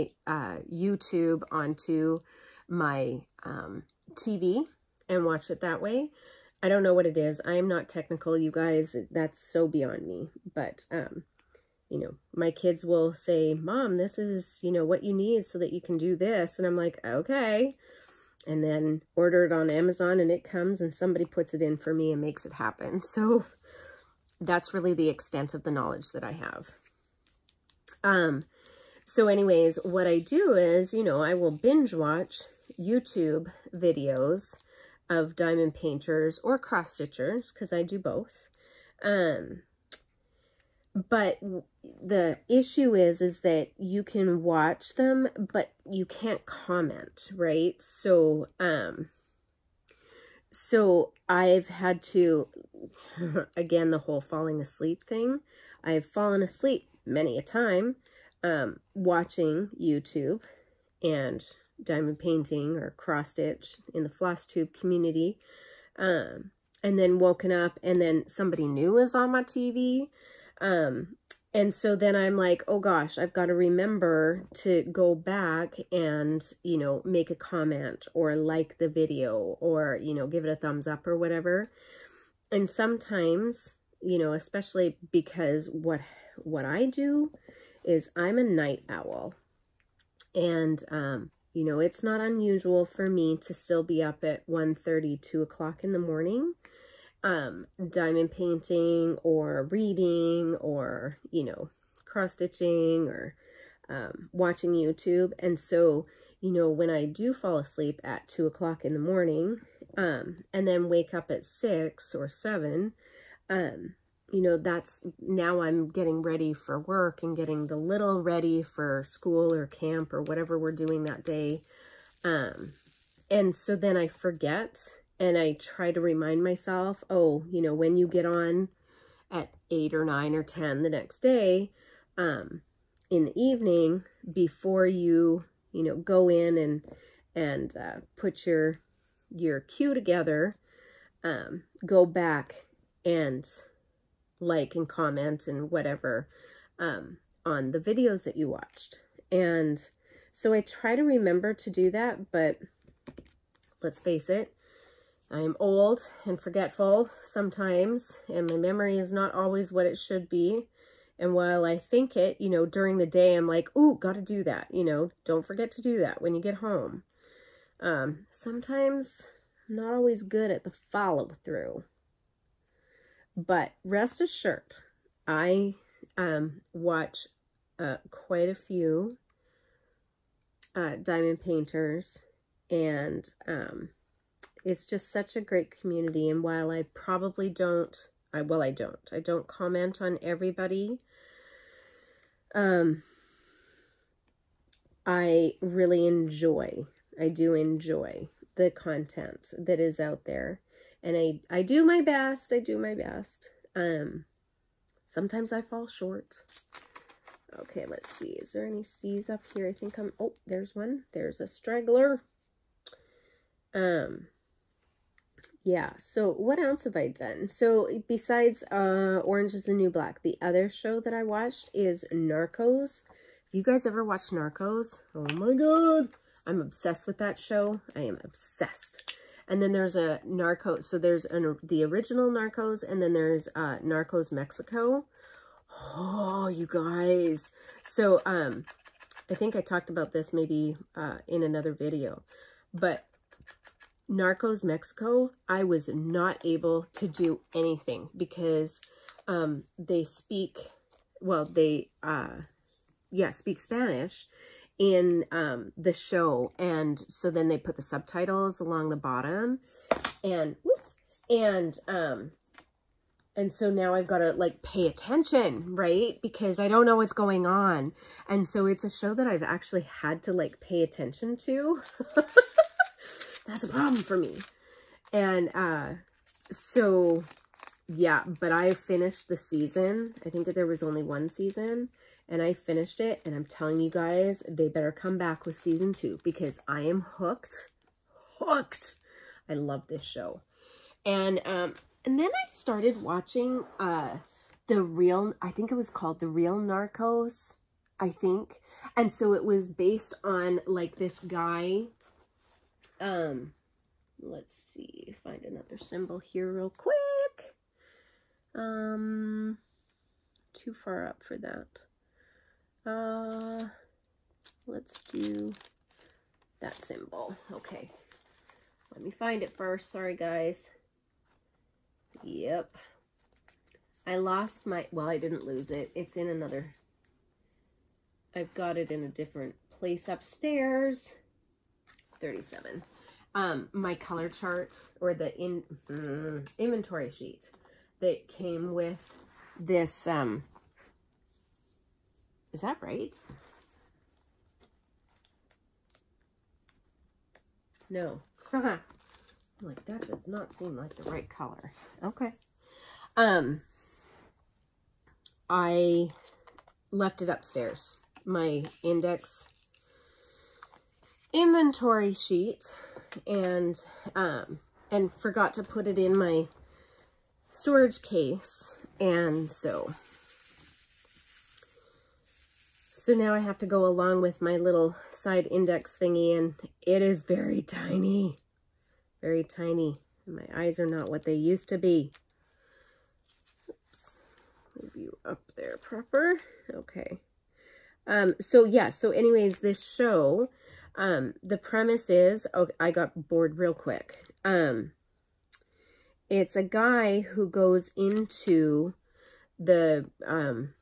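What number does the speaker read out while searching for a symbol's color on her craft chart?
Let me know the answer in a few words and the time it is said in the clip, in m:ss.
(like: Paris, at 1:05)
37, at 5:32.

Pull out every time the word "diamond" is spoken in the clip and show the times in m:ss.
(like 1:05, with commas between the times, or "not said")
0:35, 1:01, 1:37, 3:00.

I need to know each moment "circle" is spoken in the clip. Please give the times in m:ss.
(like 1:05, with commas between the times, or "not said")
not said.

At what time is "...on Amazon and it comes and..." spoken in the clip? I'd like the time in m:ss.
0:19.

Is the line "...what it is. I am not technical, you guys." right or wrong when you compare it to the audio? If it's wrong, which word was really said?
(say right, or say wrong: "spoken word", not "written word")
right.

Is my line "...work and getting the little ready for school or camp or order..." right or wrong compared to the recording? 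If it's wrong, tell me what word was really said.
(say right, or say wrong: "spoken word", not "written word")
wrong: "whatever", not "order".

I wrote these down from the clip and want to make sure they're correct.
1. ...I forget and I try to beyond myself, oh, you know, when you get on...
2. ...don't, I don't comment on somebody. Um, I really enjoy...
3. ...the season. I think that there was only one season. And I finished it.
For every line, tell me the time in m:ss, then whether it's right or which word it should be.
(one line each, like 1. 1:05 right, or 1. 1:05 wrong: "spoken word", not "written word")
1. 2:03 wrong: "remind", not "beyond"
2. 3:08 wrong: "everybody", not "somebody"
3. 4:39 right.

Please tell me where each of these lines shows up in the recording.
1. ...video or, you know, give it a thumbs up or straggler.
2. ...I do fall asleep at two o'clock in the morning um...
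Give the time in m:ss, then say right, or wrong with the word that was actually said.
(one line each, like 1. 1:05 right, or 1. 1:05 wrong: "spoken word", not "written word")
1. 1:18 wrong: "whatever", not "straggler"
2. 1:46 right.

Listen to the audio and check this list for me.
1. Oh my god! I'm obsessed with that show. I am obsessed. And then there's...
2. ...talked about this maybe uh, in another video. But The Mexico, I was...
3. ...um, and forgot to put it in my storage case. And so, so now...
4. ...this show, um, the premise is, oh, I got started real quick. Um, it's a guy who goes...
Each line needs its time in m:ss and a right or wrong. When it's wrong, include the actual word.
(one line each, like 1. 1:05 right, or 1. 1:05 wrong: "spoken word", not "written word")
1. 3:45 right
2. 3:59 wrong: "Narcos", not "The"
3. 6:04 right
4. 6:29 wrong: "bored", not "started".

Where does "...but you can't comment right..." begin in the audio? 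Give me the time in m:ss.
0:45.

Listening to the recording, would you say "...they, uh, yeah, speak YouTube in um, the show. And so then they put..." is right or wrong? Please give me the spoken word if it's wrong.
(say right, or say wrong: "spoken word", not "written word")
wrong: "Spanish", not "YouTube".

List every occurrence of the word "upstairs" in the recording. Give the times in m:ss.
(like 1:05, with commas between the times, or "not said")
5:30, 5:57.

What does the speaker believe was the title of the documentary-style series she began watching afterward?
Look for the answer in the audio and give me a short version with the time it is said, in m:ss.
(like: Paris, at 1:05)
The Real Narcos, at 4:56.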